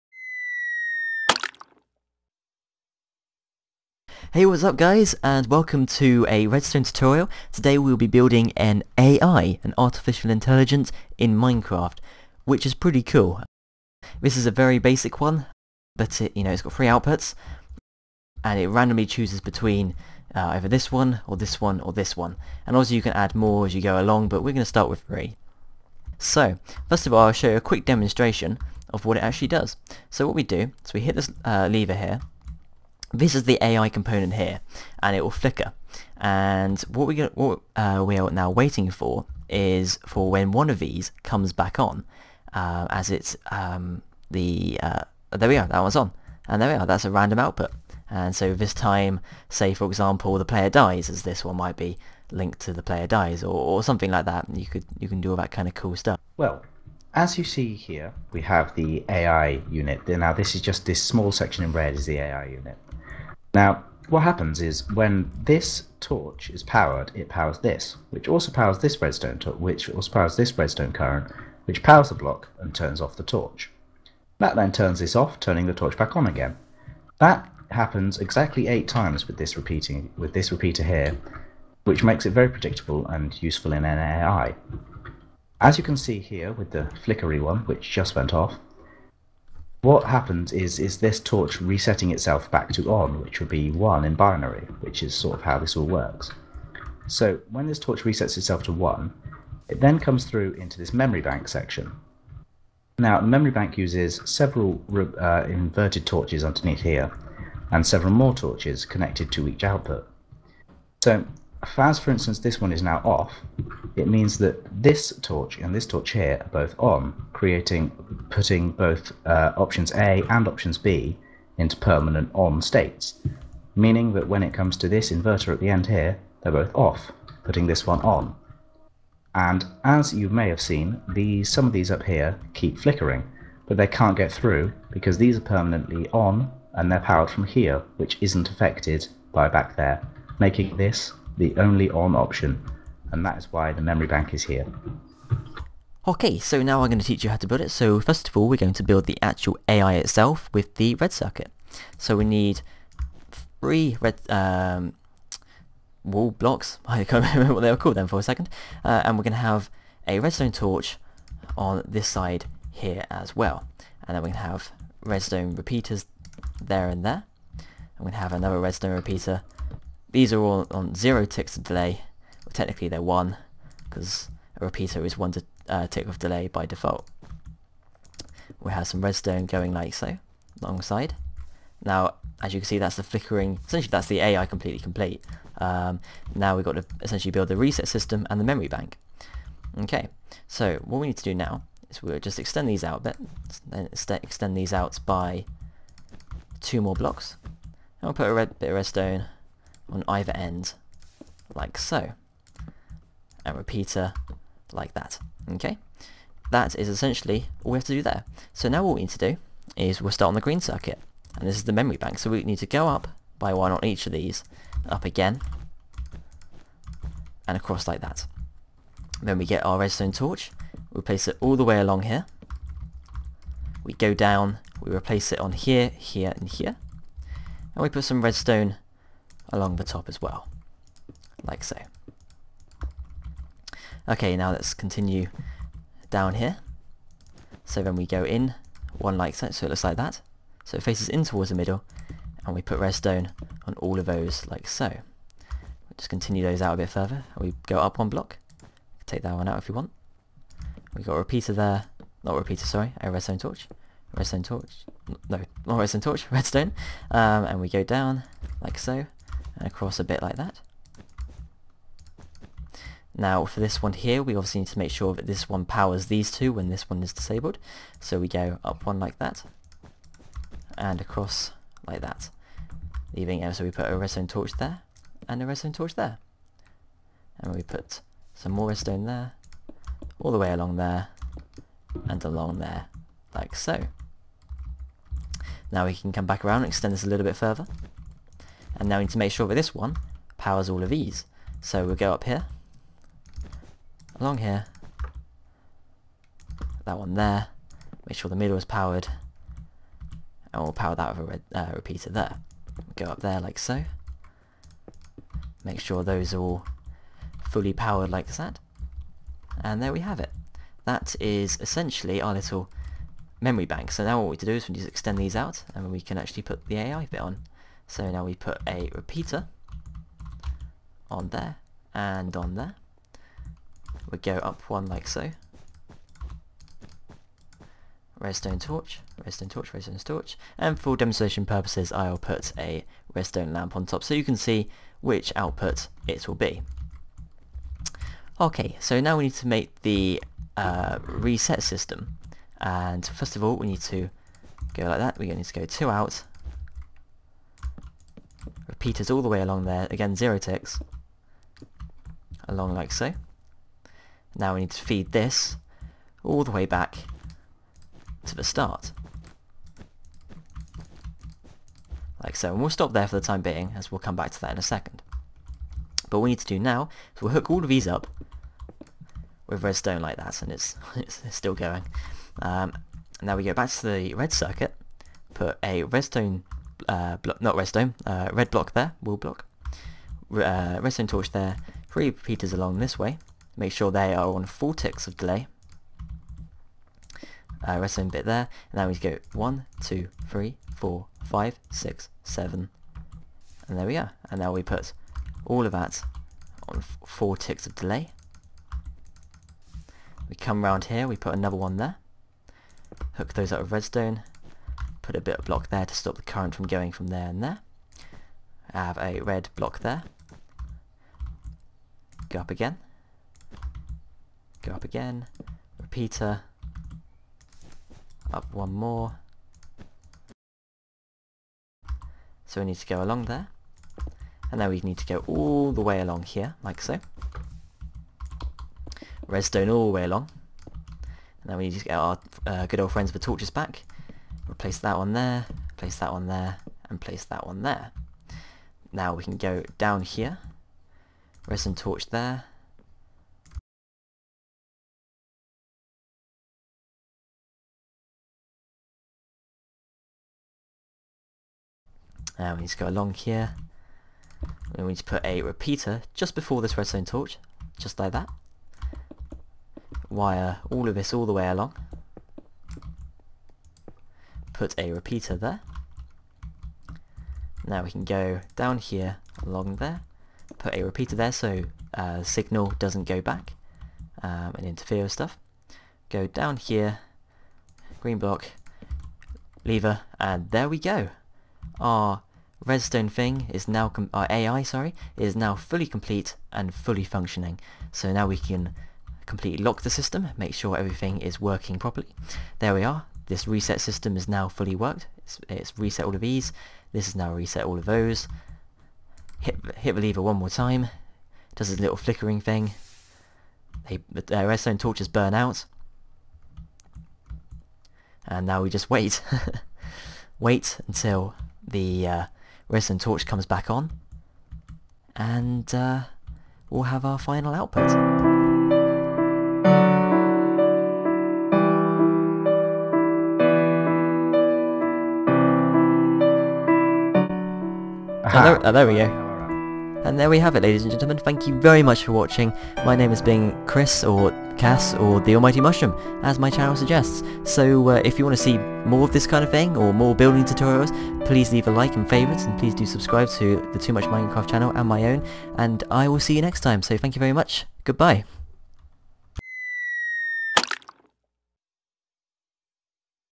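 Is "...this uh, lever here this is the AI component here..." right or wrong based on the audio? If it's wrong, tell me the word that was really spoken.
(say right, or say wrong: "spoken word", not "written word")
right.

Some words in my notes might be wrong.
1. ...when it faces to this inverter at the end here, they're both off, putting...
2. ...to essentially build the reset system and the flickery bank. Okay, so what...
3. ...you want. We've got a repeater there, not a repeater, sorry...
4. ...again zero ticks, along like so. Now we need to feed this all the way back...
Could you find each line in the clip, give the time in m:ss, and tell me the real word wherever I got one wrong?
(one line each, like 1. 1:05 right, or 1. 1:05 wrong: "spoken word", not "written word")
1. 2:04 wrong: "comes", not "faces"
2. 3:06 wrong: "memory", not "flickery"
3. 4:09 right
4. 5:49 right.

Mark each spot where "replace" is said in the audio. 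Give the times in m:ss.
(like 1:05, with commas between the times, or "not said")
3:44, 7:14.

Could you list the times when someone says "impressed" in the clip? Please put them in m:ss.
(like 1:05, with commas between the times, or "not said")
not said.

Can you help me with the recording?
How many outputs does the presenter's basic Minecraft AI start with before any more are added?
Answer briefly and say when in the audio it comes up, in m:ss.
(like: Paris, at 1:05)
3, at 0:16.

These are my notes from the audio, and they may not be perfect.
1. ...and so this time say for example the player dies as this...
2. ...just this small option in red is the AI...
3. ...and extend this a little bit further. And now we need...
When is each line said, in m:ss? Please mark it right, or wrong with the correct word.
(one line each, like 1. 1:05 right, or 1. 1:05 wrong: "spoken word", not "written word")
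1. 0:48 right
2. 1:00 wrong: "section", not "option"
3. 4:46 right.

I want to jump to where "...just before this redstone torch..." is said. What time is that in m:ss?
7:36.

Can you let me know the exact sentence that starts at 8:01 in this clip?
Our redstone thing is now, our AI, sorry, is now fully complete and fully functioning.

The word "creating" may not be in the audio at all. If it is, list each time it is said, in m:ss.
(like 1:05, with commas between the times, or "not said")
1:57.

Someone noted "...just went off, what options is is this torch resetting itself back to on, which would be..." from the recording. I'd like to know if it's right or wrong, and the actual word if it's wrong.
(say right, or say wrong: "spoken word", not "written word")
wrong: "happens", not "options".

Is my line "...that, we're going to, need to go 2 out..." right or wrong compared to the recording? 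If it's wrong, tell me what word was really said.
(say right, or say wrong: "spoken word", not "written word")
right.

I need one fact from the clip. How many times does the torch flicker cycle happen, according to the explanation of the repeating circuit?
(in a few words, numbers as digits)
8.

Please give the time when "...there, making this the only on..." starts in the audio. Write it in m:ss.
2:19.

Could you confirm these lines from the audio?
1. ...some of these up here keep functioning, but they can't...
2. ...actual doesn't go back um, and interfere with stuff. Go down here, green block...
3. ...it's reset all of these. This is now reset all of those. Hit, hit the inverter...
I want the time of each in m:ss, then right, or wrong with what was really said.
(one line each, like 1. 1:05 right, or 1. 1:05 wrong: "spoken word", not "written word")
1. 2:11 wrong: "flickering", not "functioning"
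2. 7:52 wrong: "signal", not "actual"
3. 8:15 wrong: "lever", not "inverter".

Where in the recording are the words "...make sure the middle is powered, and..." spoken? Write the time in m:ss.
4:58.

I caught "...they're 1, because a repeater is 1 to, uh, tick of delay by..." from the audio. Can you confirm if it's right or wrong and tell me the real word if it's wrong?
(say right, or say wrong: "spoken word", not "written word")
right.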